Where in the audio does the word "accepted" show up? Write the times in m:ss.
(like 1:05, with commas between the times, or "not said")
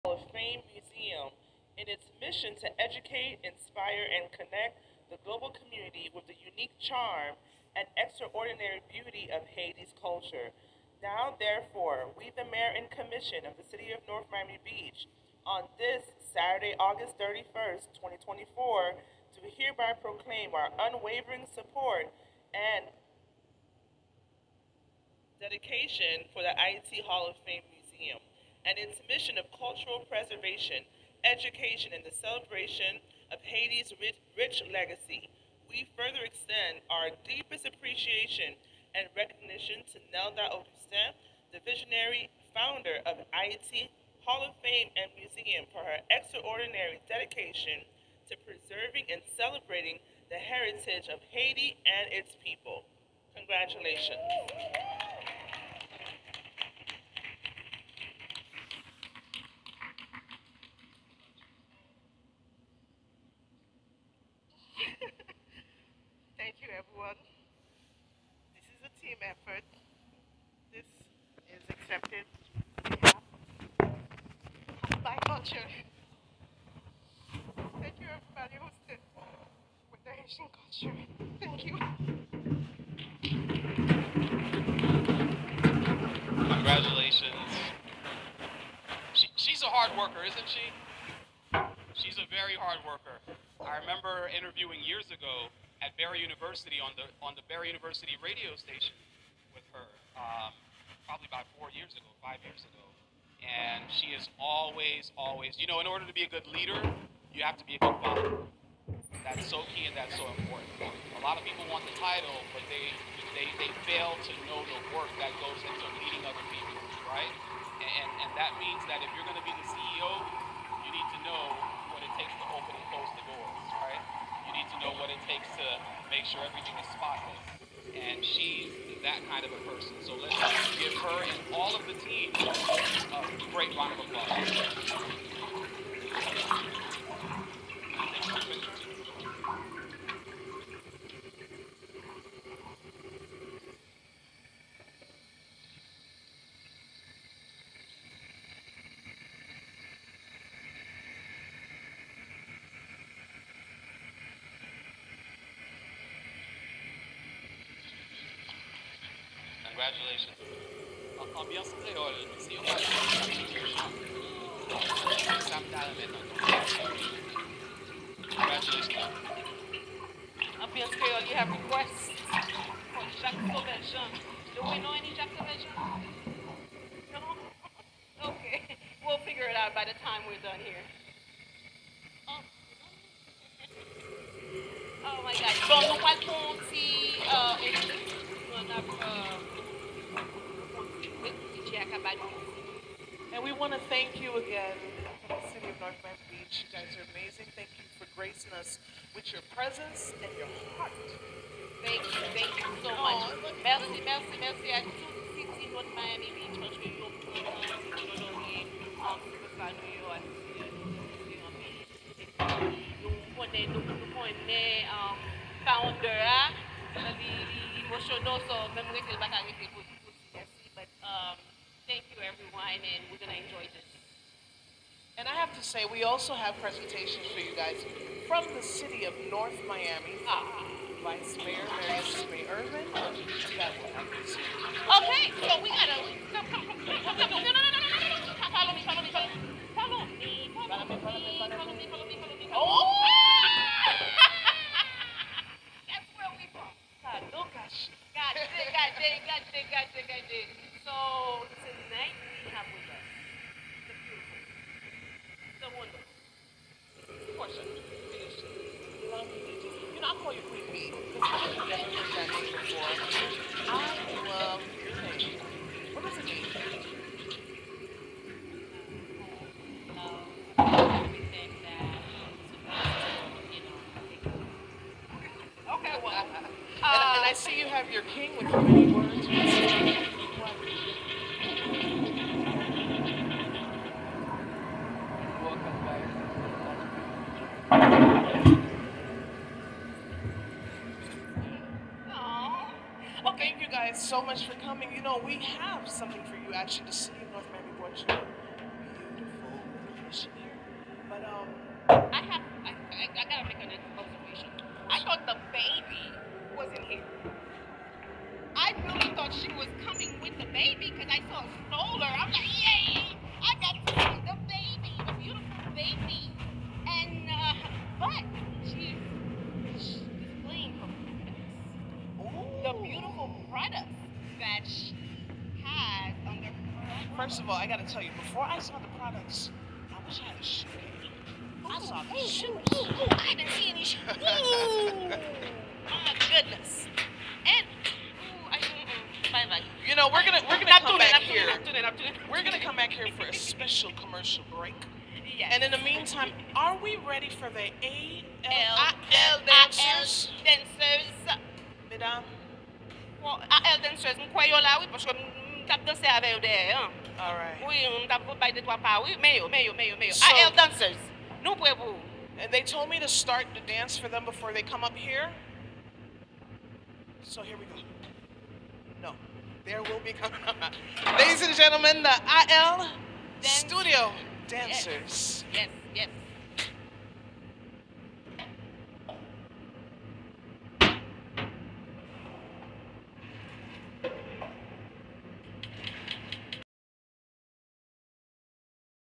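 1:11.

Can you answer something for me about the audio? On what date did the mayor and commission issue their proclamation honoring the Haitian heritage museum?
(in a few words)
August 31st, 2024.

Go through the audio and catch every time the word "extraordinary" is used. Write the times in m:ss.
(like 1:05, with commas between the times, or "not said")
0:07, 0:46.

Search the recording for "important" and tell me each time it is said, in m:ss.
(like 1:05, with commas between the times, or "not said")
1:50.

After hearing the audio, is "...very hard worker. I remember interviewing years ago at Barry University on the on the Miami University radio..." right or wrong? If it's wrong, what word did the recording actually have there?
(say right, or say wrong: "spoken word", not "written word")
wrong: "Barry", not "Miami".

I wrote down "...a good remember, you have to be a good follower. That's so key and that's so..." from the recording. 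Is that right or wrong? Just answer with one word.
wrong.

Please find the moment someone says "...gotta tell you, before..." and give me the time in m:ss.
5:27.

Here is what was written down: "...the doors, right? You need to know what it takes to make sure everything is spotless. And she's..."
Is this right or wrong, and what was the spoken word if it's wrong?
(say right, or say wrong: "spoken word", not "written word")
right.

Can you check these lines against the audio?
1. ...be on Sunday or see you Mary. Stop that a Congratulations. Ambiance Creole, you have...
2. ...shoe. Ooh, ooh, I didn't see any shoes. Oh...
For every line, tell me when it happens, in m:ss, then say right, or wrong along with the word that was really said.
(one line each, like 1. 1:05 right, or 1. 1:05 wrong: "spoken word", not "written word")
1. 2:41 wrong: "Monday", not "Mary"
2. 5:32 right.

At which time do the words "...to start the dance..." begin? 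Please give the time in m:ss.
6:02.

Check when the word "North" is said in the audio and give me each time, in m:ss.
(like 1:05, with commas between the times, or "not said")
0:14, 3:15, 3:25, 3:49, 4:57.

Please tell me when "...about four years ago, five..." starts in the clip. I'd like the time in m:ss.
1:41.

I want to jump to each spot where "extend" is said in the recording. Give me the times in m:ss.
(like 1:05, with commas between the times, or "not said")
0:36.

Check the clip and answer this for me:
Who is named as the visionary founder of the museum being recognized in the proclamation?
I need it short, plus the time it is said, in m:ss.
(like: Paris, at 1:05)
Nelda Augustin, at 0:40.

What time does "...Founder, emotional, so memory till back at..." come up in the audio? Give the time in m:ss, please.
3:35.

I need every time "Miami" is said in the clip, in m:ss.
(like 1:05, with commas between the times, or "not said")
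0:14, 3:16, 3:25, 3:49, 4:57.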